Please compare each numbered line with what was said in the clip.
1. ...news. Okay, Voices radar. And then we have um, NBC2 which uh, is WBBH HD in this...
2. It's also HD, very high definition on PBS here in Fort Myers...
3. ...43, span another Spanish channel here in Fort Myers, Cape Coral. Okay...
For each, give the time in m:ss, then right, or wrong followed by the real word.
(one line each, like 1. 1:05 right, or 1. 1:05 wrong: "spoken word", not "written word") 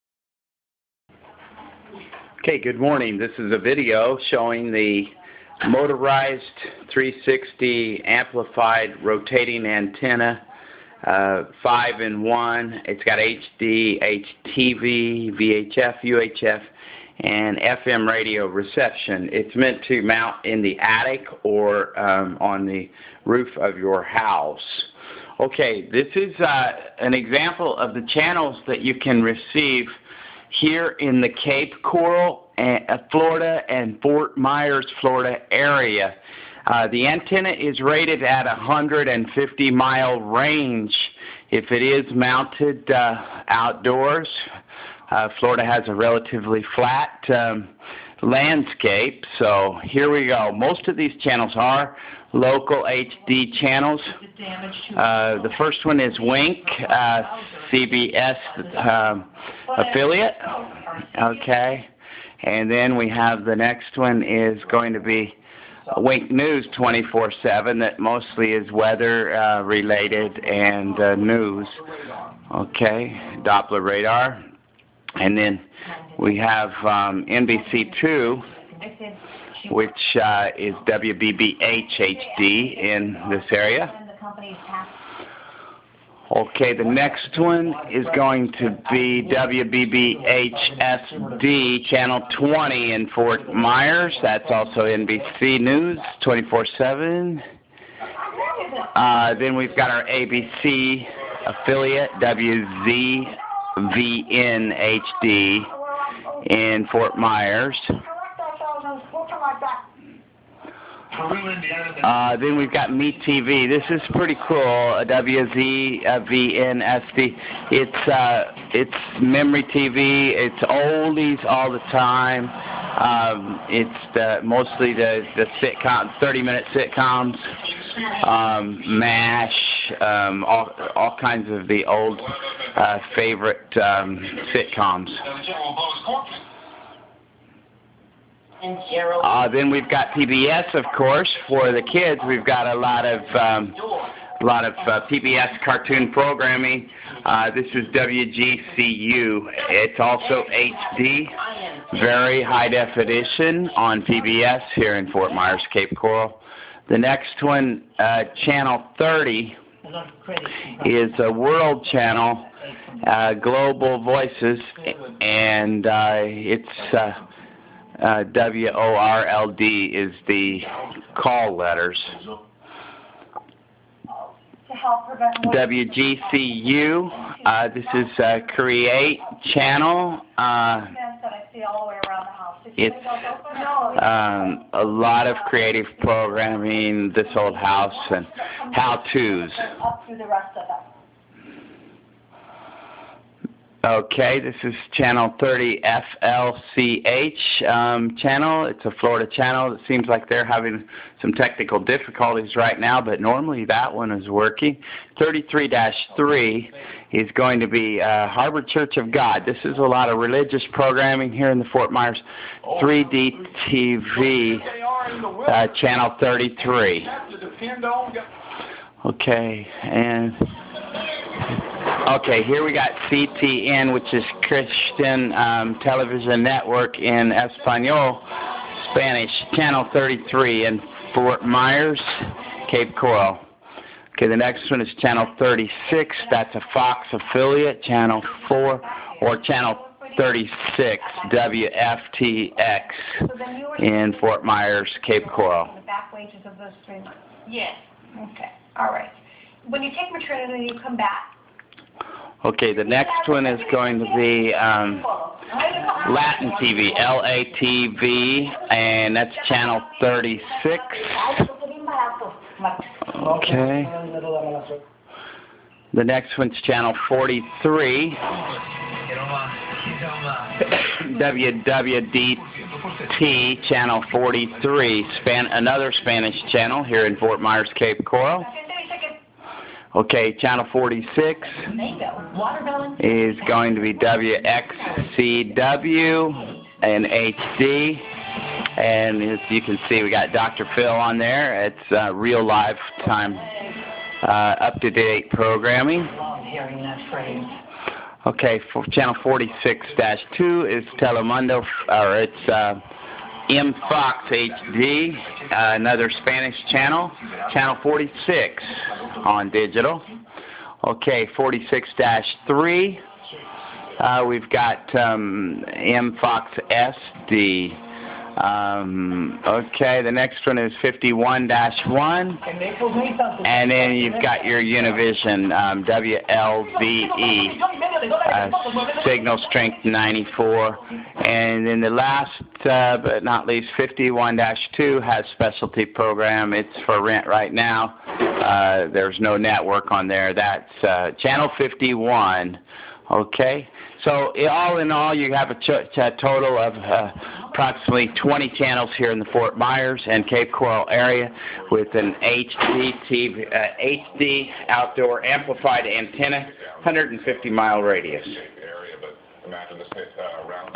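1. 1:11 wrong: "Doppler", not "Voices"
2. 2:29 right
3. 4:34 right.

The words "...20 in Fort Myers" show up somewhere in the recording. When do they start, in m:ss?
1:32.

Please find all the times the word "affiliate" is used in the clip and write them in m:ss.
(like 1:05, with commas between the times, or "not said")
0:59, 1:41, 3:57.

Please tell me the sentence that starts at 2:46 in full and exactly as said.
Uh, uh, WORLD is the call letters.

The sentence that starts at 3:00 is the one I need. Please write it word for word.
Uh, it's um, a lot of creative programming, this old house, and how-tos.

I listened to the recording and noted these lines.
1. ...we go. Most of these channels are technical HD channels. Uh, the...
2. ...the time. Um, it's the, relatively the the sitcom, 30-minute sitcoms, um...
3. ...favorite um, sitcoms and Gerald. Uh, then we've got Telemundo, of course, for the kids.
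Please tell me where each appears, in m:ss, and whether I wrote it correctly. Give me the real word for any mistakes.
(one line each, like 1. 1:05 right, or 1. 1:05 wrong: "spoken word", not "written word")
1. 0:50 wrong: "local", not "technical"
2. 2:01 wrong: "mostly", not "relatively"
3. 2:13 wrong: "PBS", not "Telemundo".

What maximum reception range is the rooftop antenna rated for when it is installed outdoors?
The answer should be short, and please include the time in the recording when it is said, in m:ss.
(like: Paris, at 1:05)
150 mile range, at 0:38.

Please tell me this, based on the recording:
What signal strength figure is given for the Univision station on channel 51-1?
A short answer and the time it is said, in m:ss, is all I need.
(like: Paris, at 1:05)
94, at 5:29.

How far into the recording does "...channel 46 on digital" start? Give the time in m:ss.
5:07.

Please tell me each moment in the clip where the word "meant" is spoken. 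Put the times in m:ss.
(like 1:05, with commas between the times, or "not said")
0:19.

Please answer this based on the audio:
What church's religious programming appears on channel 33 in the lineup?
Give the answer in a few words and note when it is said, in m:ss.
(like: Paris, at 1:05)
Harbor Church of God, at 3:28.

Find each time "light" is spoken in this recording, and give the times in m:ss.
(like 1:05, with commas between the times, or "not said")
not said.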